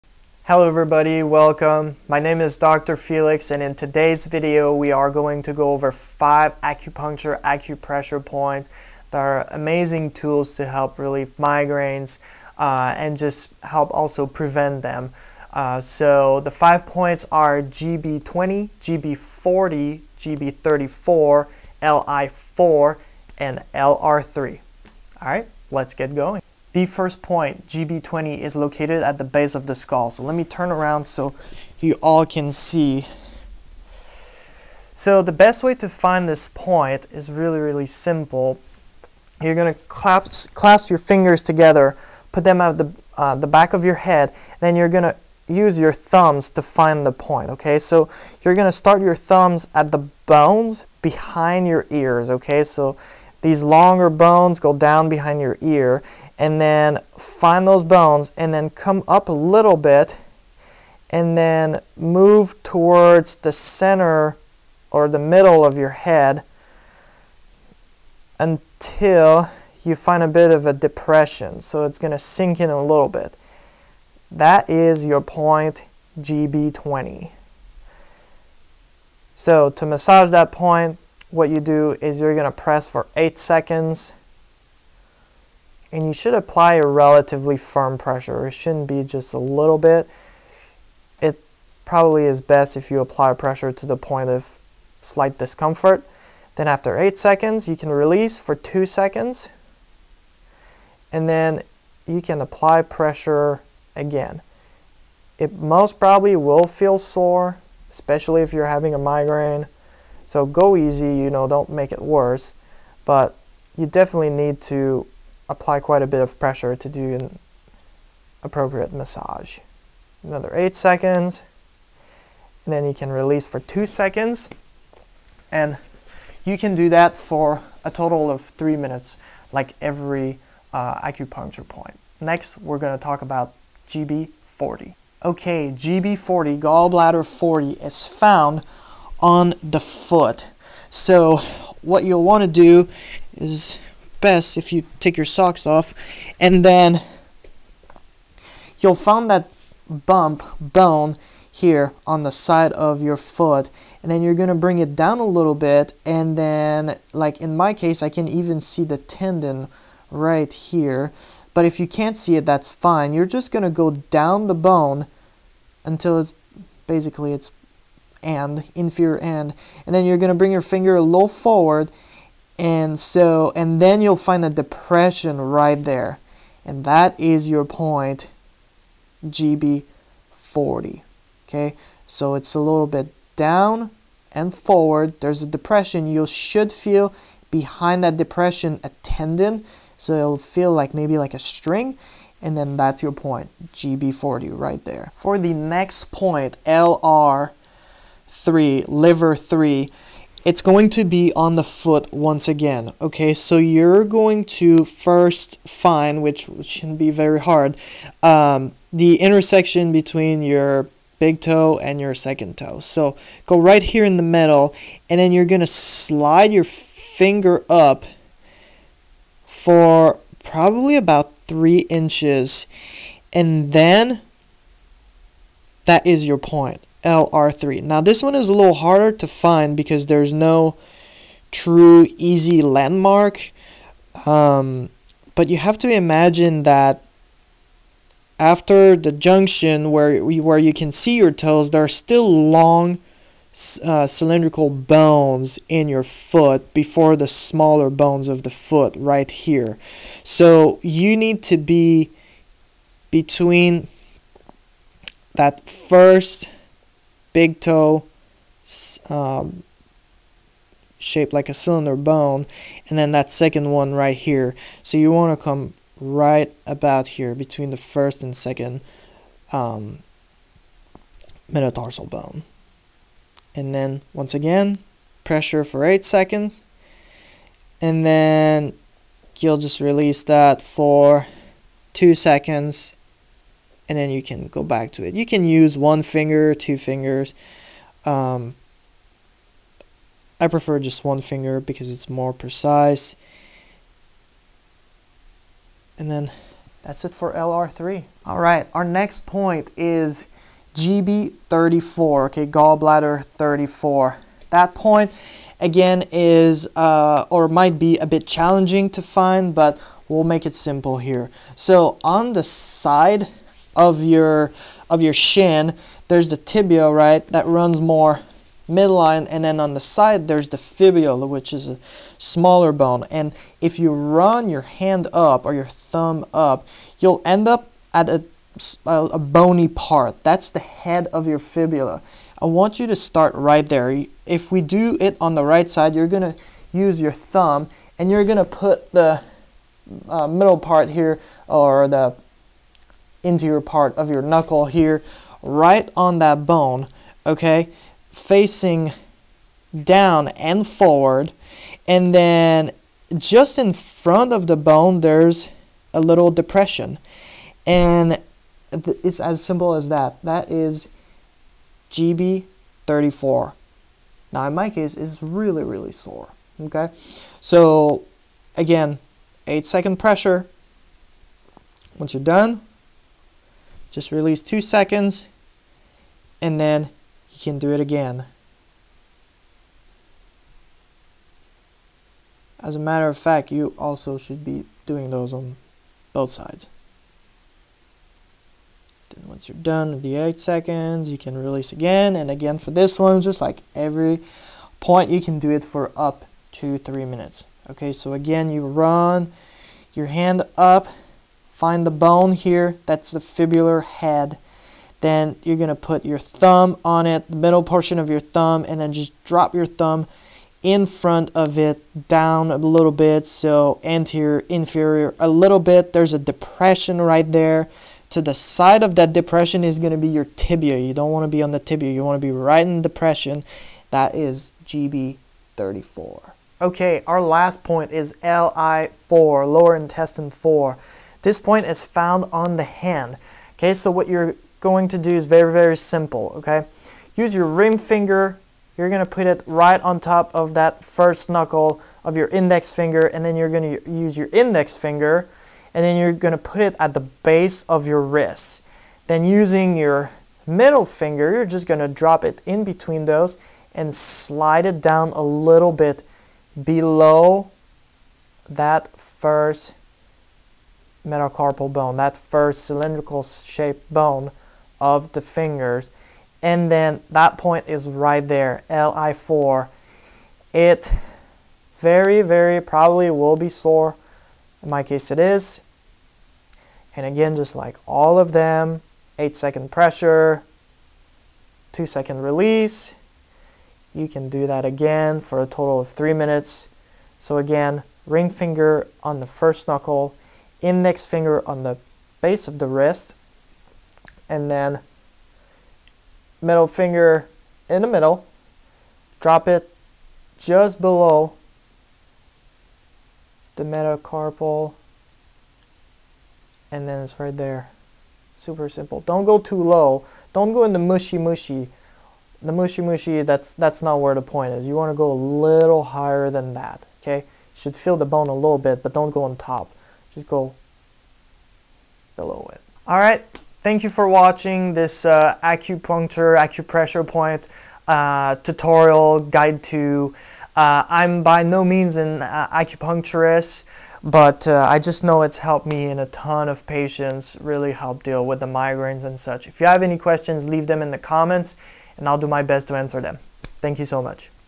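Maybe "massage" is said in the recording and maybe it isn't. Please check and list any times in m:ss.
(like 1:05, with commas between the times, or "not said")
1:19, 1:58.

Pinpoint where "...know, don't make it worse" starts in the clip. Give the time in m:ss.
1:51.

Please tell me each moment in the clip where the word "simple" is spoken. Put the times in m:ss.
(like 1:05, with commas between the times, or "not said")
0:37, 5:10, 5:59, 7:15, 8:28.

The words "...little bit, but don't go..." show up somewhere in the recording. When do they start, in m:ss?
8:38.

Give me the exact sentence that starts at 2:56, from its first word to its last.
And that is your point GB40.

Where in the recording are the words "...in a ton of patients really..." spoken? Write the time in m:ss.
8:55.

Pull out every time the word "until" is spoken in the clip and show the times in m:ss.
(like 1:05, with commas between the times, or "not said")
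1:08, 2:45.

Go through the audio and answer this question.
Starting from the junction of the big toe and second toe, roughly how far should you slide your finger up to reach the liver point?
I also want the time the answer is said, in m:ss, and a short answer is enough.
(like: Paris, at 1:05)
About three inches, at 3:40.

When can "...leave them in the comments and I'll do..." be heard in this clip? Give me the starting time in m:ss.
9:00.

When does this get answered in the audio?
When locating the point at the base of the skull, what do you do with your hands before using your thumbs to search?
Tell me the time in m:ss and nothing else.
0:40.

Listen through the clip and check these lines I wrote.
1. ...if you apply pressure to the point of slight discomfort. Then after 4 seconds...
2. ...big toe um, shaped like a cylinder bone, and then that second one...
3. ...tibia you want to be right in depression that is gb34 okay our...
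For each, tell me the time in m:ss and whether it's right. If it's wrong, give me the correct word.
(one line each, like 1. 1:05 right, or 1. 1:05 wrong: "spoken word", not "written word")
1. 1:32 wrong: "8", not "4"
2. 4:17 right
3. 7:01 right.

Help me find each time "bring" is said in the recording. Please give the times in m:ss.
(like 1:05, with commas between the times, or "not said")
2:34, 2:50.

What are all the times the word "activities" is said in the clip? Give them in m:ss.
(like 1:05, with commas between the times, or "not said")
not said.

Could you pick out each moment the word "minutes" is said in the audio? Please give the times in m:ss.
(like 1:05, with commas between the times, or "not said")
2:08, 6:37, 8:06.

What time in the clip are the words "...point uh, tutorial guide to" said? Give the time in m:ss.
8:47.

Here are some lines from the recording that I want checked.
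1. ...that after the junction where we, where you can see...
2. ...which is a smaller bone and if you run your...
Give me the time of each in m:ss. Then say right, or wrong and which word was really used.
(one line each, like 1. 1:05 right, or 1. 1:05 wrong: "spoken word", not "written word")
1. 3:56 right
2. 5:21 right.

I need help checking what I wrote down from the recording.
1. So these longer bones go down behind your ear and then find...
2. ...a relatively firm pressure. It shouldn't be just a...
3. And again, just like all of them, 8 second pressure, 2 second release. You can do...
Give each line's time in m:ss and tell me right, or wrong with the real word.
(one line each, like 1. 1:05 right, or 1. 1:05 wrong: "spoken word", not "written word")
1. 0:52 right
2. 1:26 right
3. 7:56 right.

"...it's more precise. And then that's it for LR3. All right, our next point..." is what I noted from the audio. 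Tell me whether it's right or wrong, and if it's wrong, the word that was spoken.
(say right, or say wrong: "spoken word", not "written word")
right.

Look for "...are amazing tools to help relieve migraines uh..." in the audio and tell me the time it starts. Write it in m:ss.
0:09.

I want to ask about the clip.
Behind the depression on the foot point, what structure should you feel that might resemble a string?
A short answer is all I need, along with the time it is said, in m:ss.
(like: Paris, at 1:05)
A tendon, at 3:08.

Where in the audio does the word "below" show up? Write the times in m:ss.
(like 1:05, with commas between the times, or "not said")
7:36, 8:20, 8:42.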